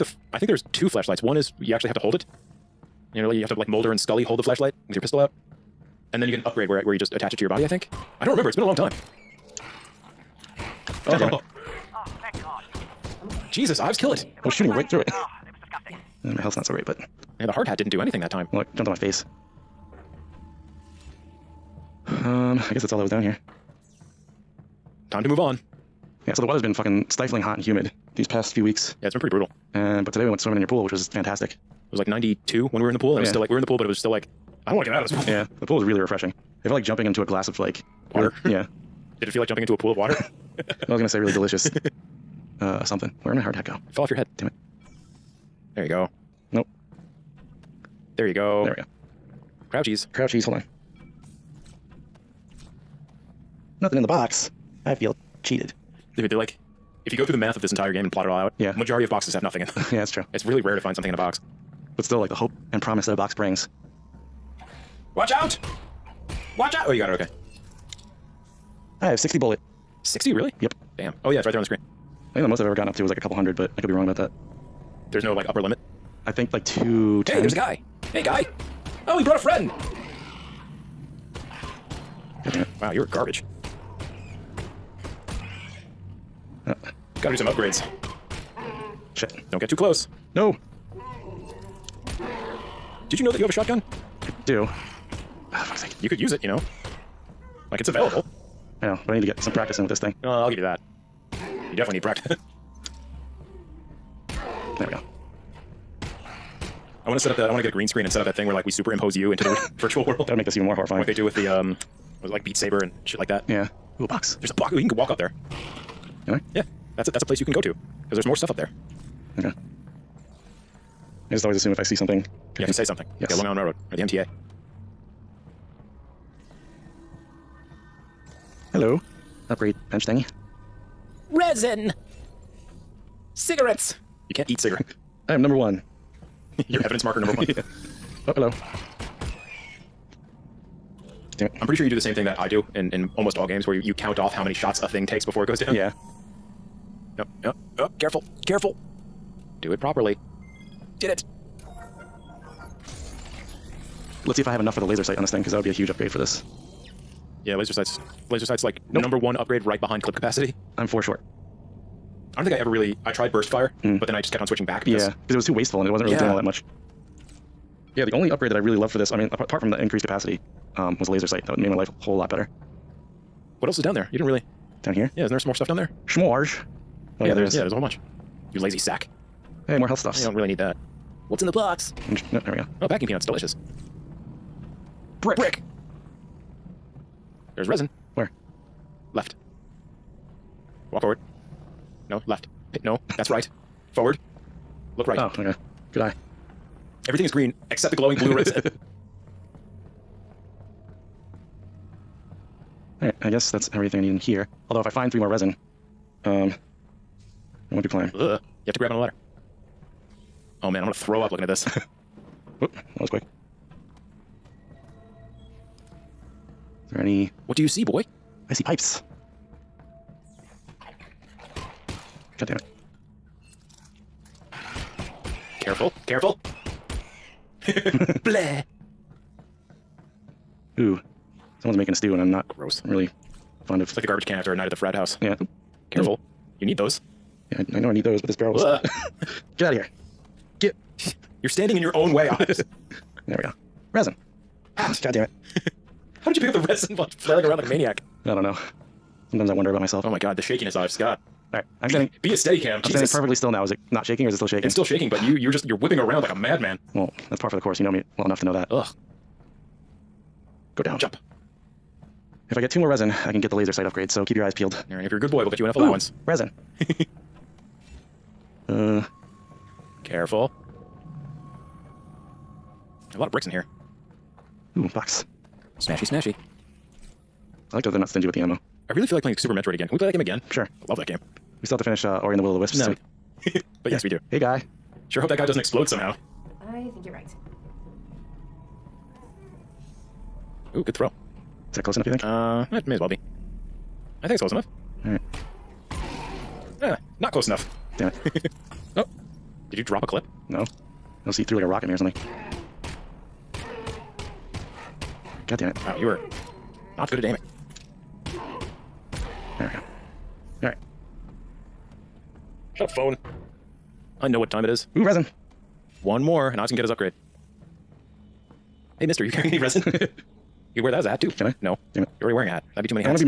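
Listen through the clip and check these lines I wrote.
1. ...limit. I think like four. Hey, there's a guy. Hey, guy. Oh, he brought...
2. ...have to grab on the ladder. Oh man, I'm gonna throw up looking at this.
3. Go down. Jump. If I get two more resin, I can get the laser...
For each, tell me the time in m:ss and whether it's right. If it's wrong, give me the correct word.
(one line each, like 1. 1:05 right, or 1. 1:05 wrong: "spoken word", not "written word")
1. 1:15 wrong: "two", not "four"
2. 3:28 right
3. 4:20 right.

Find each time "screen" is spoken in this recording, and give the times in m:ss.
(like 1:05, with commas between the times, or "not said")
1:11, 1:47.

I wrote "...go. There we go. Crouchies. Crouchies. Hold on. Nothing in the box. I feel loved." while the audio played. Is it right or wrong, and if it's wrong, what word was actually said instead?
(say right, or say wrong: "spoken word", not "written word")
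wrong: "cheated", not "loved".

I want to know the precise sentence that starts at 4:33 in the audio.
A lot of bricks in here.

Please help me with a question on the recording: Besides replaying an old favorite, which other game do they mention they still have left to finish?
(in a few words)
Ori and the Will of the Wisps.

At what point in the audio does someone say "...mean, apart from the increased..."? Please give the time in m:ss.
2:49.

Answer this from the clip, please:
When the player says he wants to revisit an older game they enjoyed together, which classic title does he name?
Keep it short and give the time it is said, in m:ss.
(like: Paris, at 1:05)
Super Metroid, at 4:39.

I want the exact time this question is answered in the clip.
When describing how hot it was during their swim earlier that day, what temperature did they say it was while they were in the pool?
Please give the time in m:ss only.
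0:32.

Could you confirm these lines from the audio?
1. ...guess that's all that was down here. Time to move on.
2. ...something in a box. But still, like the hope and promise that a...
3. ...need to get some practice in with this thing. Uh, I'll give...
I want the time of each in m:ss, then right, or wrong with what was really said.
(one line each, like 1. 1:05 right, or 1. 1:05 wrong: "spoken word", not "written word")
1. 0:22 right
2. 1:00 right
3. 1:39 right.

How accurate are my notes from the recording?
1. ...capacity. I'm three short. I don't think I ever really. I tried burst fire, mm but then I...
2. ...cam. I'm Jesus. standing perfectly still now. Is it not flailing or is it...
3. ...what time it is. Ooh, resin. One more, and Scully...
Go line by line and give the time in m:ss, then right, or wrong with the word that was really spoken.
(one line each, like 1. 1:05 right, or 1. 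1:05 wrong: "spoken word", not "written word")
1. 2:40 wrong: "four", not "three"
2. 4:12 wrong: "shaking", not "flailing"
3. 5:14 wrong: "Ives", not "Scully".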